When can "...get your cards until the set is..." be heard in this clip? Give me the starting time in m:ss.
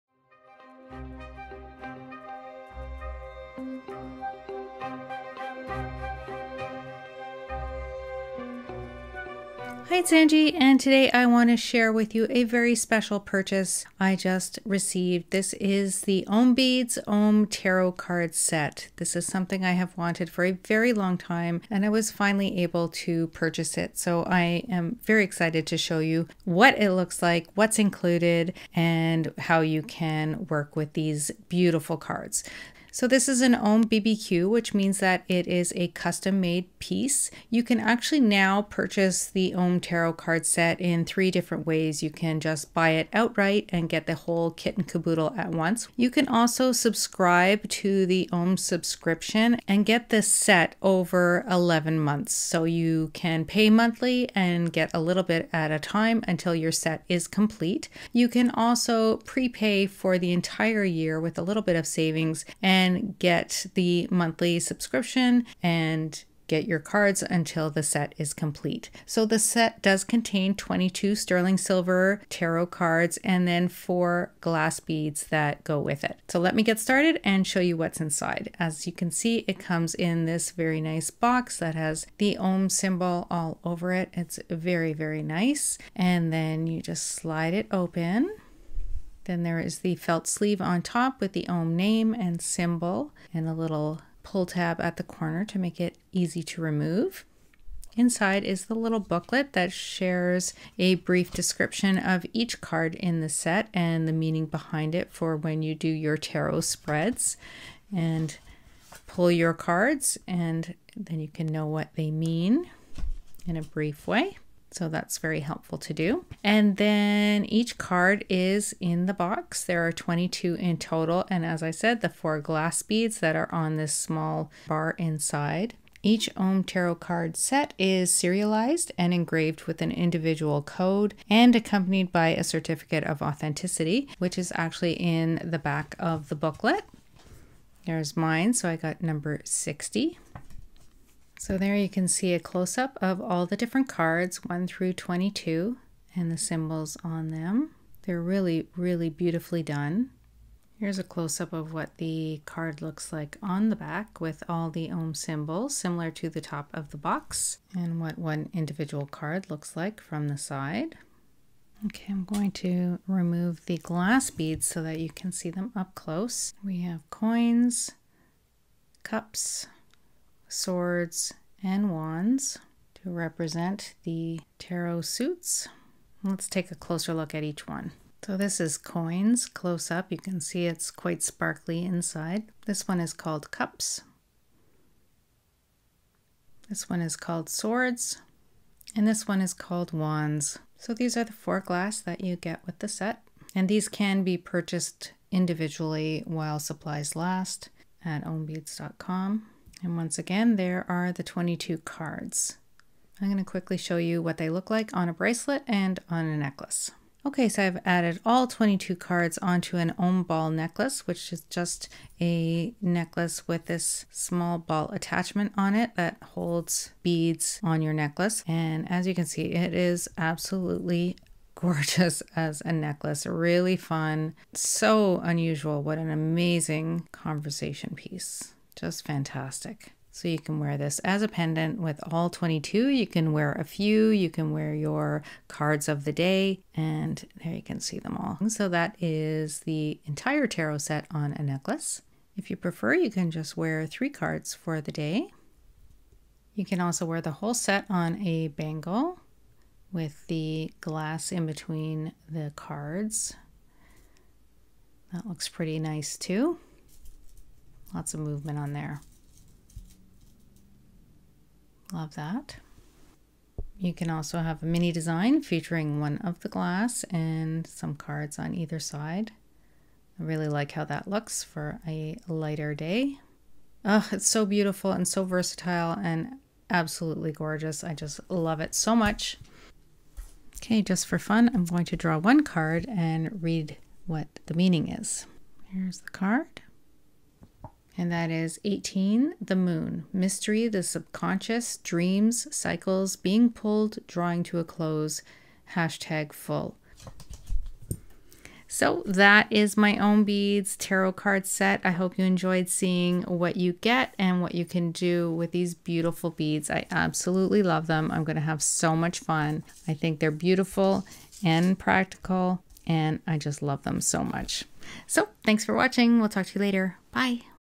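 1:06.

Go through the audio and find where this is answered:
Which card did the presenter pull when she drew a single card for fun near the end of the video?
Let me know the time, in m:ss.
4:49.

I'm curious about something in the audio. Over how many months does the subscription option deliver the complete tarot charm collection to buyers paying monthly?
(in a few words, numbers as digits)
11.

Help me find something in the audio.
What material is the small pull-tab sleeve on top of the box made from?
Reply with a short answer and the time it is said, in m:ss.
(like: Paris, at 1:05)
Felt, at 1:29.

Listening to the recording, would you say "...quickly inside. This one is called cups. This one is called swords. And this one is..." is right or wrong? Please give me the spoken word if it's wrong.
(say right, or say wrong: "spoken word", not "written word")
wrong: "sparkly", not "quickly".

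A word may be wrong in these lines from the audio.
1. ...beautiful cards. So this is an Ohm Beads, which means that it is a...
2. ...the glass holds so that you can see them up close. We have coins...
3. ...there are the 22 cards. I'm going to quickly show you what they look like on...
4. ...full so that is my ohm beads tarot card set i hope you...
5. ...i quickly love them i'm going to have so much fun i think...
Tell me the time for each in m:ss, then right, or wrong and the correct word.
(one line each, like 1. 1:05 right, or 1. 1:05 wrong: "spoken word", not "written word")
1. 0:31 wrong: "BBQ", not "Beads"
2. 2:43 wrong: "beads", not "holds"
3. 3:20 right
4. 4:56 right
5. 5:06 wrong: "absolutely", not "quickly".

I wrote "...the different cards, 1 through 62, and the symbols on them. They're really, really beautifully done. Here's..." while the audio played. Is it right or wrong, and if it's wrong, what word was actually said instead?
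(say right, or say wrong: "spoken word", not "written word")
wrong: "22", not "62".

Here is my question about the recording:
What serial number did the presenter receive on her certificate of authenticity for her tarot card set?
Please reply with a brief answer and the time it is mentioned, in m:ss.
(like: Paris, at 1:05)
60, at 2:19.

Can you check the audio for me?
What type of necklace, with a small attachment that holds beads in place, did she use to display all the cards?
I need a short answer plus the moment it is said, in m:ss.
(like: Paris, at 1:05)
Ohm ball necklace, at 3:29.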